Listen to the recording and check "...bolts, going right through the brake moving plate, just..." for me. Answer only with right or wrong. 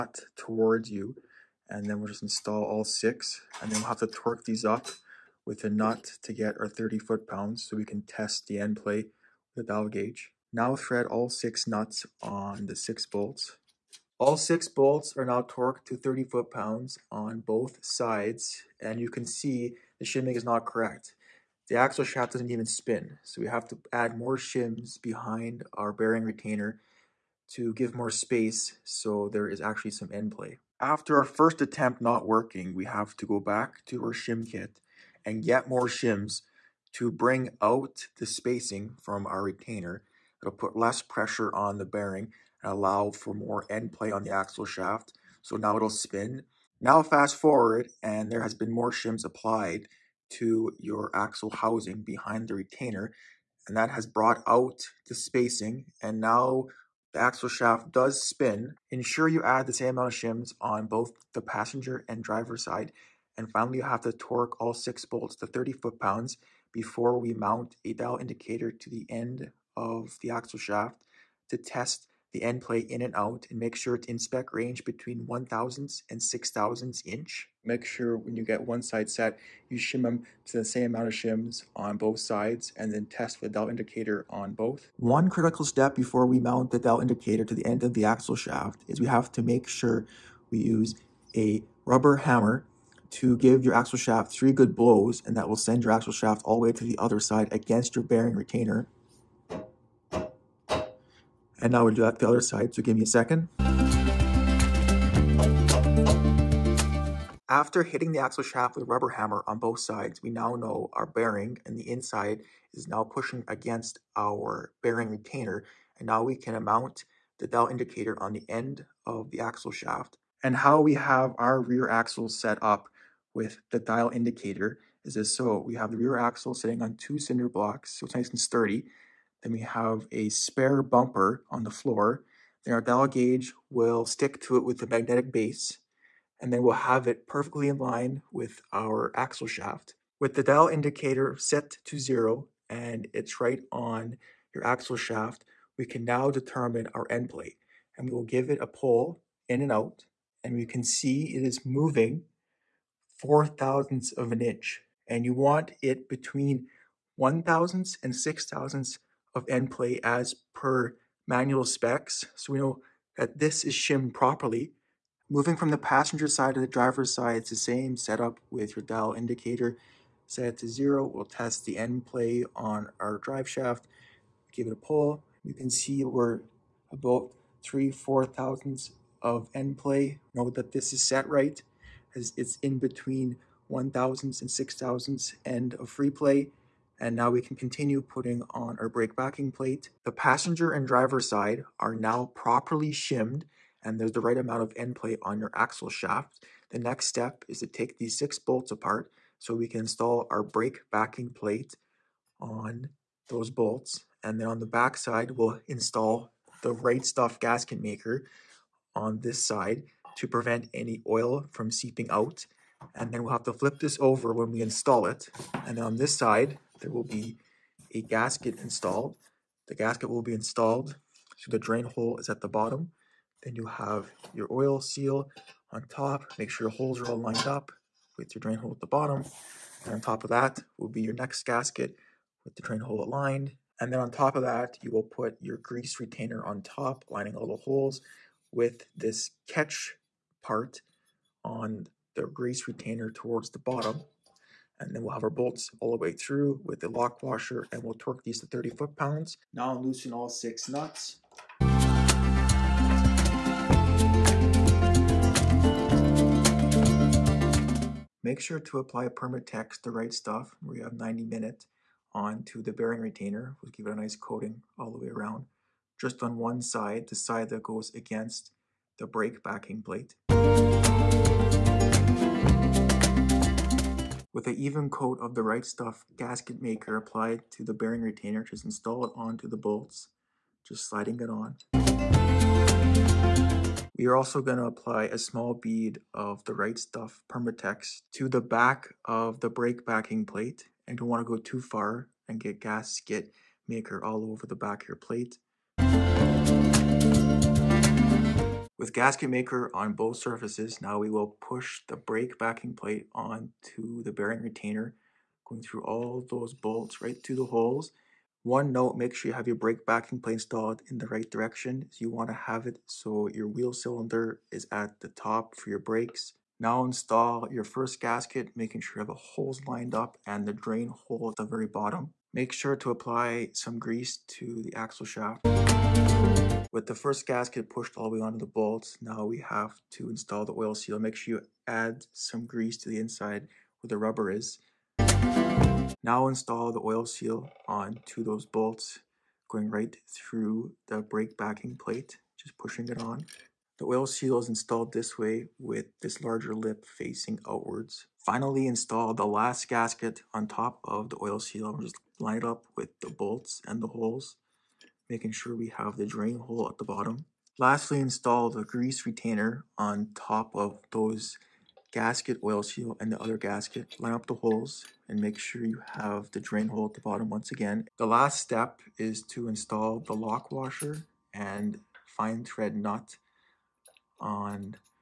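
wrong.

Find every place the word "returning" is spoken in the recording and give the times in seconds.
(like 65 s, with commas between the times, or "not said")
not said.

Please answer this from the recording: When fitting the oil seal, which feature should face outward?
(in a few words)
larger lip.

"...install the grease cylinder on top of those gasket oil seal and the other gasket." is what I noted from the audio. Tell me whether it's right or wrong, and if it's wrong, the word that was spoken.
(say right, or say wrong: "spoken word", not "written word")
wrong: "retainer", not "cylinder".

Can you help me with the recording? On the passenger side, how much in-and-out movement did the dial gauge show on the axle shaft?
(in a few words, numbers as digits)
4 thousandths of an inch.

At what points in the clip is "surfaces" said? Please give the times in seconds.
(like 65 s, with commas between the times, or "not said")
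300 s.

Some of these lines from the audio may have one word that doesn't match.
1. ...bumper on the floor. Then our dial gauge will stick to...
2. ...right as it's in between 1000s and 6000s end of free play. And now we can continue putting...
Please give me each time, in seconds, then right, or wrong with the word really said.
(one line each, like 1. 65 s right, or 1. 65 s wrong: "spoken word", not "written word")
1. 130 s right
2. 181 s right.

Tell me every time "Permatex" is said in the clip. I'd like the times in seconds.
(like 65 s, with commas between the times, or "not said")
259 s, 287 s.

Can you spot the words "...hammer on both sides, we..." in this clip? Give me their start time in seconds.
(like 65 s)
109 s.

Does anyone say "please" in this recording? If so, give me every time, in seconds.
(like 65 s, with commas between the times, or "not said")
not said.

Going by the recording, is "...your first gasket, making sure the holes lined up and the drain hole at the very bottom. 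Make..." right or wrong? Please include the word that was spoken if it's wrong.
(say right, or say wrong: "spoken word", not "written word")
right.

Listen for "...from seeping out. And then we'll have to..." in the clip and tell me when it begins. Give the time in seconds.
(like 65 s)
211 s.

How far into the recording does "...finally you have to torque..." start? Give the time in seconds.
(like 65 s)
63 s.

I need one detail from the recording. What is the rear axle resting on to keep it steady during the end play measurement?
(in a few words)
two cinder blocks.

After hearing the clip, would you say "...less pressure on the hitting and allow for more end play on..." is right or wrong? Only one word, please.
wrong.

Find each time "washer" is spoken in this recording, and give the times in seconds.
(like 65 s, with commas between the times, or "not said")
247 s, 370 s.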